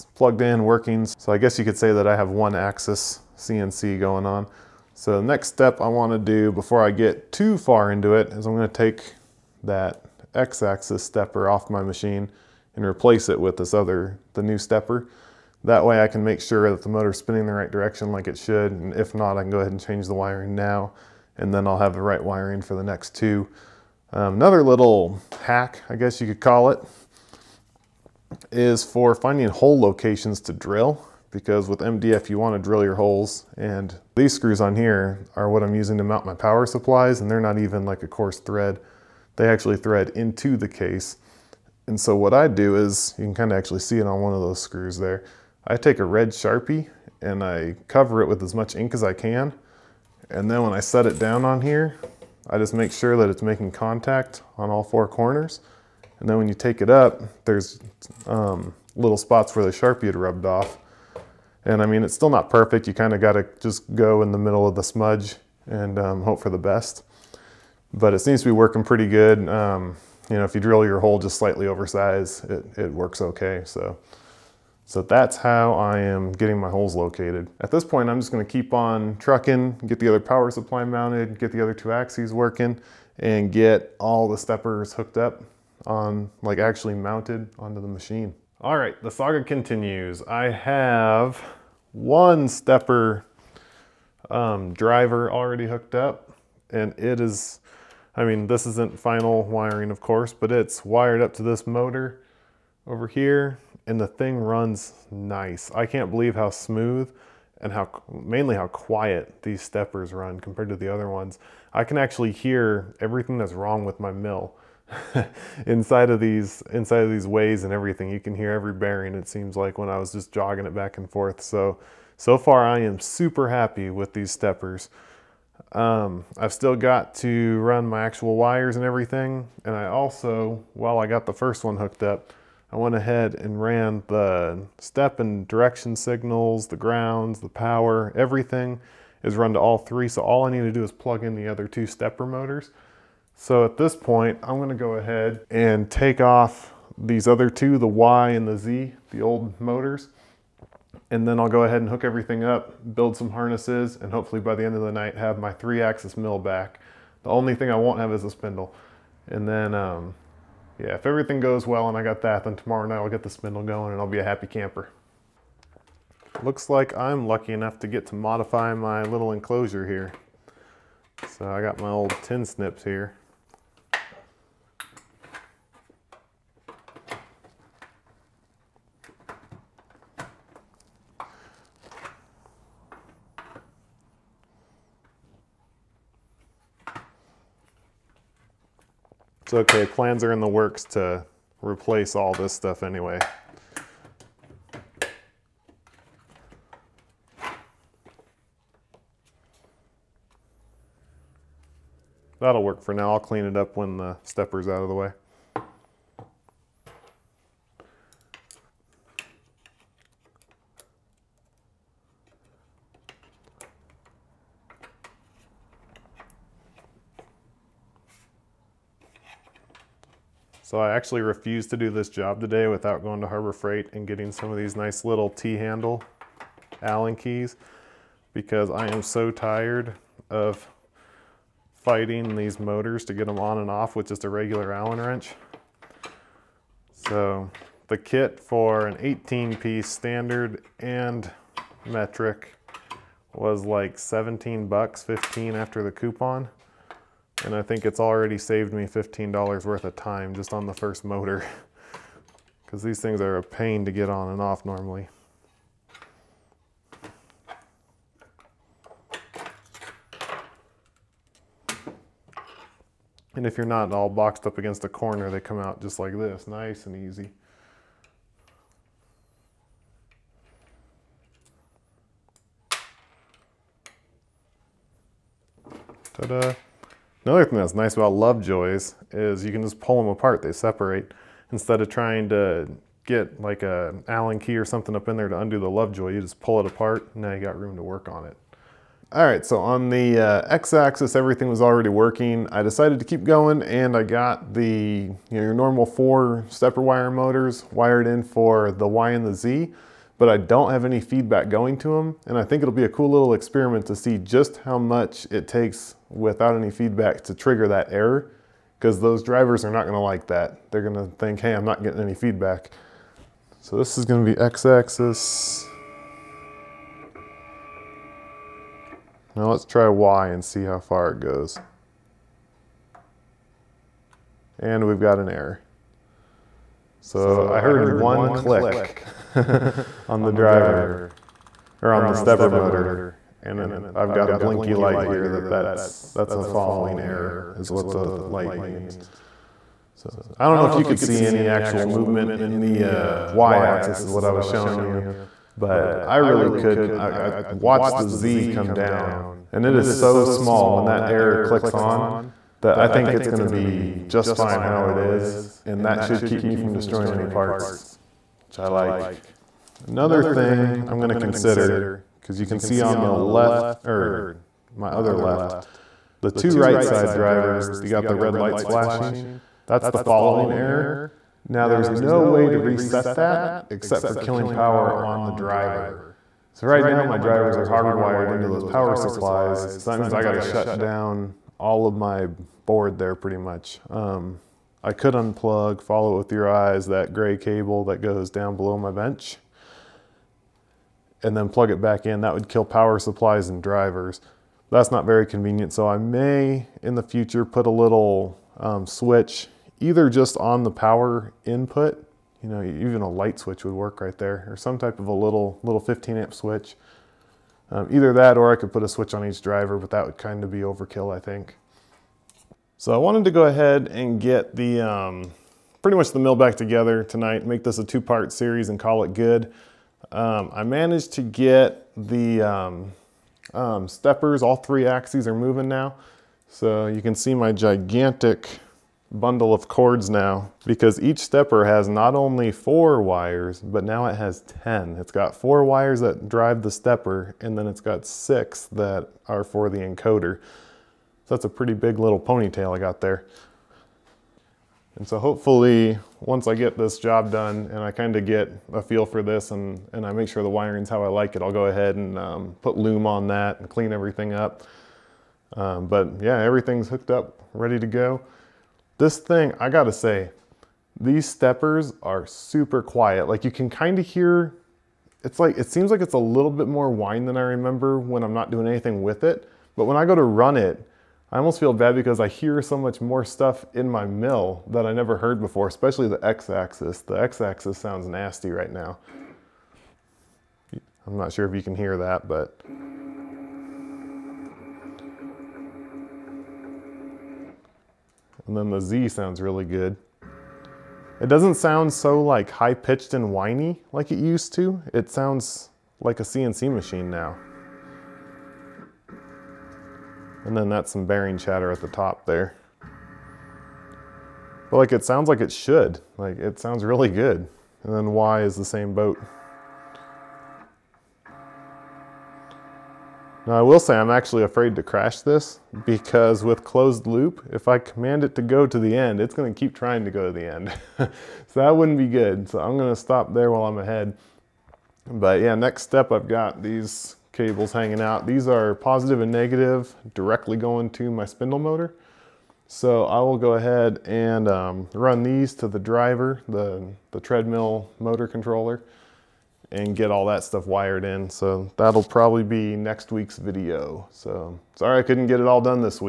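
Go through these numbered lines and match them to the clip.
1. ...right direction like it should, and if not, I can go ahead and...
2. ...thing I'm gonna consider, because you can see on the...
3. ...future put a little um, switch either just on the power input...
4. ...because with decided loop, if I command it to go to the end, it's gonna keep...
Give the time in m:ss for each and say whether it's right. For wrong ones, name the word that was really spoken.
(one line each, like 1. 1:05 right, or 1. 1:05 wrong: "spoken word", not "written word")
1. 0:17 right
2. 6:00 right
3. 6:37 right
4. 8:35 wrong: "closed", not "decided".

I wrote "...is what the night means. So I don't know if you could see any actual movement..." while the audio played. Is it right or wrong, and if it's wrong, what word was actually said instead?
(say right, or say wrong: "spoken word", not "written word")
wrong: "light", not "night".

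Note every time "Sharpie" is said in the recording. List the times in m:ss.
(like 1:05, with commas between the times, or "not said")
0:46, 0:59.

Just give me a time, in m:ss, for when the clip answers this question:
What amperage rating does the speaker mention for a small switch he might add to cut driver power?
6:45.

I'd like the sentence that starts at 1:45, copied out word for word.
I can't believe how smooth and how mainly how quiet these steppers run compared to the other ones.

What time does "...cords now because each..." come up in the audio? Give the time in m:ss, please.
7:09.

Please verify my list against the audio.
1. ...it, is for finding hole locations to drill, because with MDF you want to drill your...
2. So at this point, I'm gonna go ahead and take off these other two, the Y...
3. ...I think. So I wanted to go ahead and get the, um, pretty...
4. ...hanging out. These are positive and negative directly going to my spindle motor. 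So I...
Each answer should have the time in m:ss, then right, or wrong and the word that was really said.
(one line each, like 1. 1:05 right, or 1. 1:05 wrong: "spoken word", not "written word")
1. 0:26 right
2. 2:23 right
3. 6:51 right
4. 8:47 right.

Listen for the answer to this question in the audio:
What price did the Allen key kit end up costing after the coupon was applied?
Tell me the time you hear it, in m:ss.
4:05.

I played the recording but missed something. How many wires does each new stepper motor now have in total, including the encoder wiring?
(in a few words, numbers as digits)
10.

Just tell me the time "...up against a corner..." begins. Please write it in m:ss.
4:24.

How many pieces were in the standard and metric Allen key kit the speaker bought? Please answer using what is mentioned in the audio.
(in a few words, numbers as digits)
18.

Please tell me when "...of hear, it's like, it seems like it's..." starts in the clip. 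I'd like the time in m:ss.
7:43.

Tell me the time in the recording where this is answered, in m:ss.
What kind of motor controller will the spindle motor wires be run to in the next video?
8:57.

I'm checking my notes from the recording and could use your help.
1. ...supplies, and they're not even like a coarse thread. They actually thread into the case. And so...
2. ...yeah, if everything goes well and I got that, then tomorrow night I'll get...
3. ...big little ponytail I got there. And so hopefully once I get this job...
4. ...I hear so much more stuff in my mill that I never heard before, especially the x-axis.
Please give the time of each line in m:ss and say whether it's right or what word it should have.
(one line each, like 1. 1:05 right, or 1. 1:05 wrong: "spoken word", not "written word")
1. 0:36 right
2. 2:40 right
3. 7:21 right
4. 7:52 right.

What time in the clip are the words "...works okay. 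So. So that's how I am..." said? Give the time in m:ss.
1:12.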